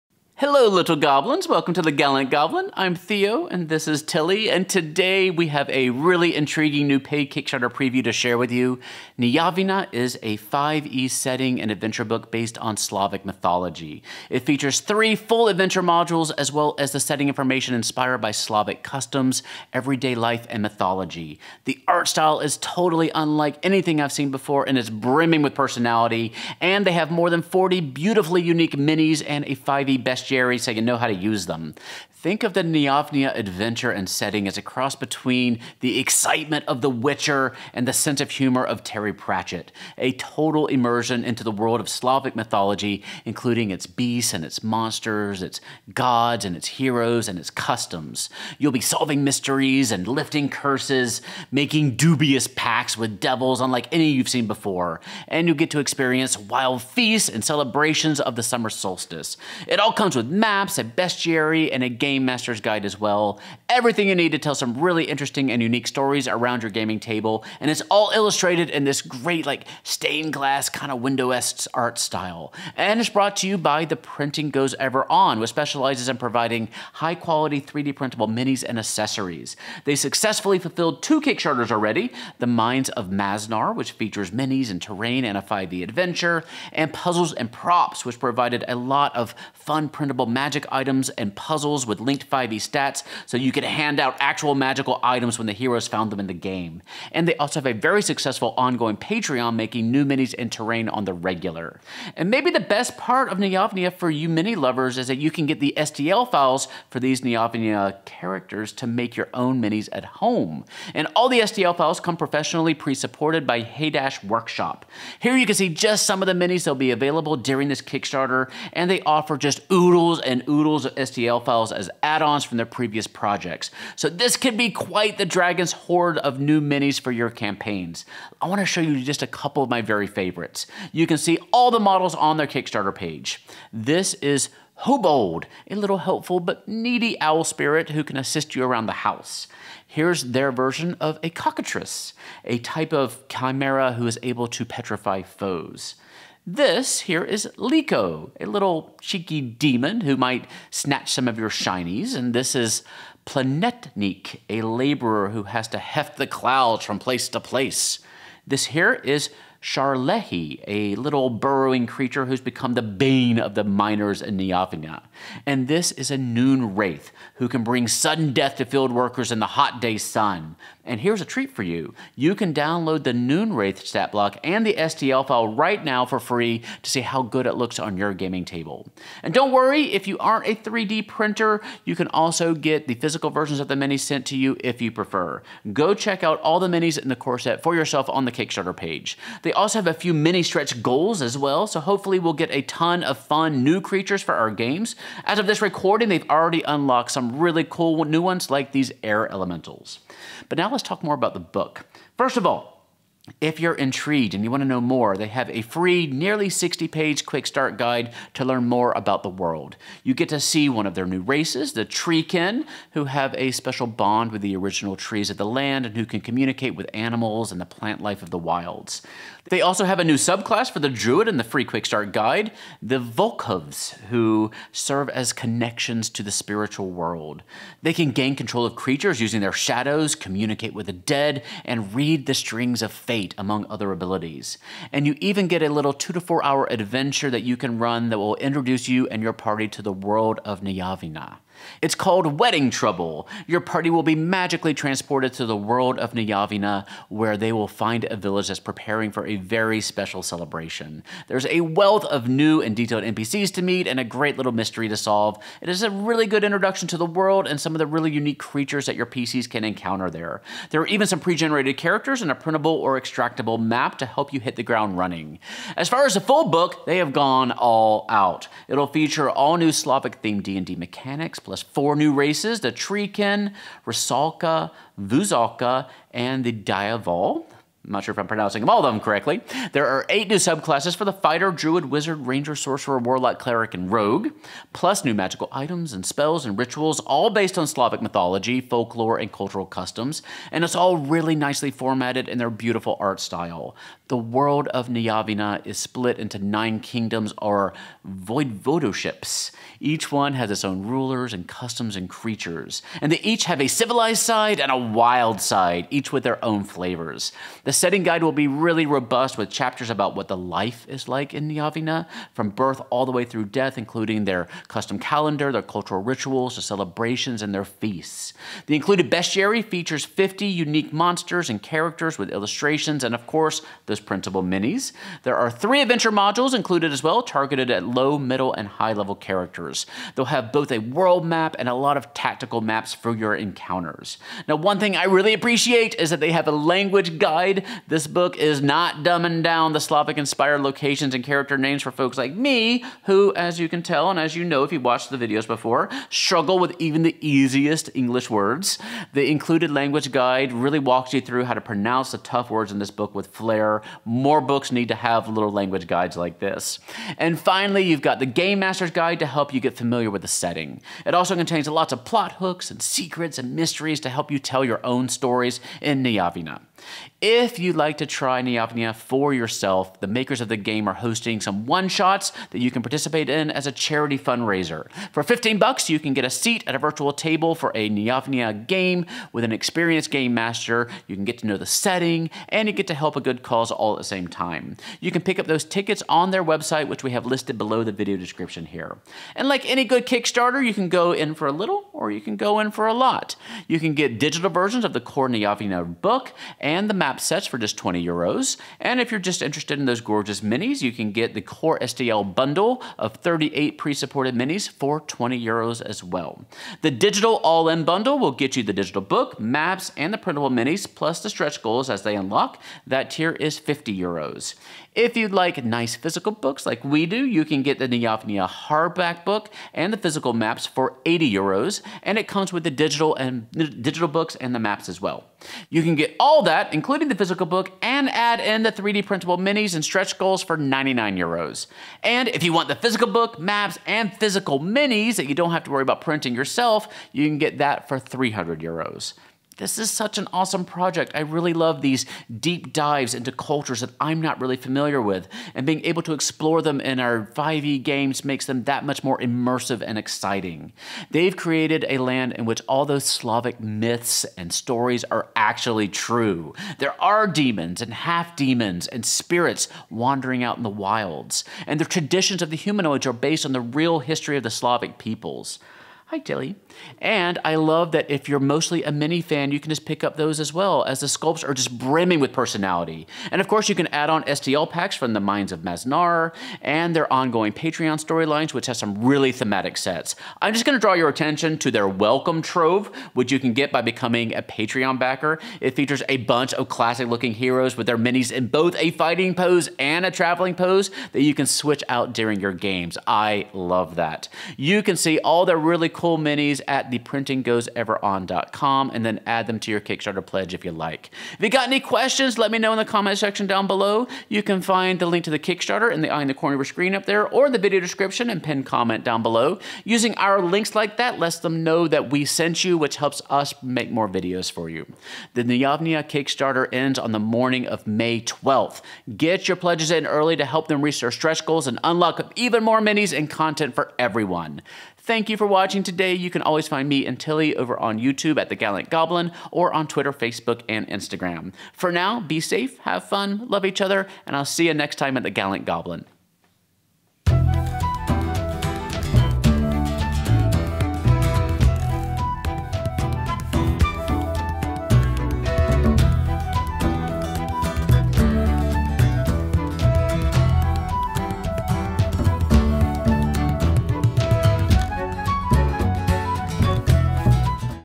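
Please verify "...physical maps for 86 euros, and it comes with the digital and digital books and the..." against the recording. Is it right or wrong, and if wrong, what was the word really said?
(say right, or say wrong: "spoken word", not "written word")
wrong: "80", not "86".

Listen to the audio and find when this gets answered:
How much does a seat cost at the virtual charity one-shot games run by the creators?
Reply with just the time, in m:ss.
6:15.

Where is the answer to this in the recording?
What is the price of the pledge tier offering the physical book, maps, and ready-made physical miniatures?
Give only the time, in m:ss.
7:17.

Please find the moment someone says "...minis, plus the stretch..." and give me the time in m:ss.
6:50.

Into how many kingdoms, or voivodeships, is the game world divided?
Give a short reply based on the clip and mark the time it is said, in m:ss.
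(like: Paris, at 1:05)
9, at 4:56.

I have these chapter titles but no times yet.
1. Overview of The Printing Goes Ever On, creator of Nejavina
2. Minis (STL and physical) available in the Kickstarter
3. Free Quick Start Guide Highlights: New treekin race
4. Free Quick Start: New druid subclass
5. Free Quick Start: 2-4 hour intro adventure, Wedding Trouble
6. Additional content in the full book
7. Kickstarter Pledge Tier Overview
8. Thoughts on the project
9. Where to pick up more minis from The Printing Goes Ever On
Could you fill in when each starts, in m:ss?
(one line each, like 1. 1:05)
1. 1:12
2. 1:42
3. 3:20
4. 3:39
5. 3:55
6. 4:25
7. 6:29
8. 7:19
9. 7:47.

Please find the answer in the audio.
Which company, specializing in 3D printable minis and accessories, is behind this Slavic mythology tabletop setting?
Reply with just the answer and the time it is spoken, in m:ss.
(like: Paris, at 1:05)
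The Printing Goes Ever On, at 1:13.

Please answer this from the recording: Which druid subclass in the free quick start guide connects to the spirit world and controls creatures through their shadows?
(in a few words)
Volkovs.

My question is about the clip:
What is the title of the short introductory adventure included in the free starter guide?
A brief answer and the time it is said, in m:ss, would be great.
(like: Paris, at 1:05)
Wedding Trouble, at 4:02.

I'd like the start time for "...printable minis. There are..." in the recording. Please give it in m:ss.
5:24.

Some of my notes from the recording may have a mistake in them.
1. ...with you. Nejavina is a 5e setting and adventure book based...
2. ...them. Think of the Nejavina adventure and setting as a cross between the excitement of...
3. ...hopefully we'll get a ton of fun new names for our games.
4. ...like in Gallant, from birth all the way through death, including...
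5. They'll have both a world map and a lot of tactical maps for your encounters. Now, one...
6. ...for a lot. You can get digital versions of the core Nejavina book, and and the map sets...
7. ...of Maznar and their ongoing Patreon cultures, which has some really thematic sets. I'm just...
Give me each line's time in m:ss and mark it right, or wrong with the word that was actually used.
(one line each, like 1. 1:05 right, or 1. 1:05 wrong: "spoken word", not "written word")
1. 0:08 right
2. 0:31 right
3. 3:11 wrong: "creatures", not "names"
4. 5:11 wrong: "Nejavina", not "Gallant"
5. 5:30 right
6. 6:32 right
7. 7:55 wrong: "storylines", not "cultures".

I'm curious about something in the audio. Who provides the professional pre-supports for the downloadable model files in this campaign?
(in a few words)
Haydash Workshop.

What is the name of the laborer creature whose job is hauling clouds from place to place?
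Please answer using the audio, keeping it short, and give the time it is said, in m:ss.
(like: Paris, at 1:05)
Planetnik, at 2:33.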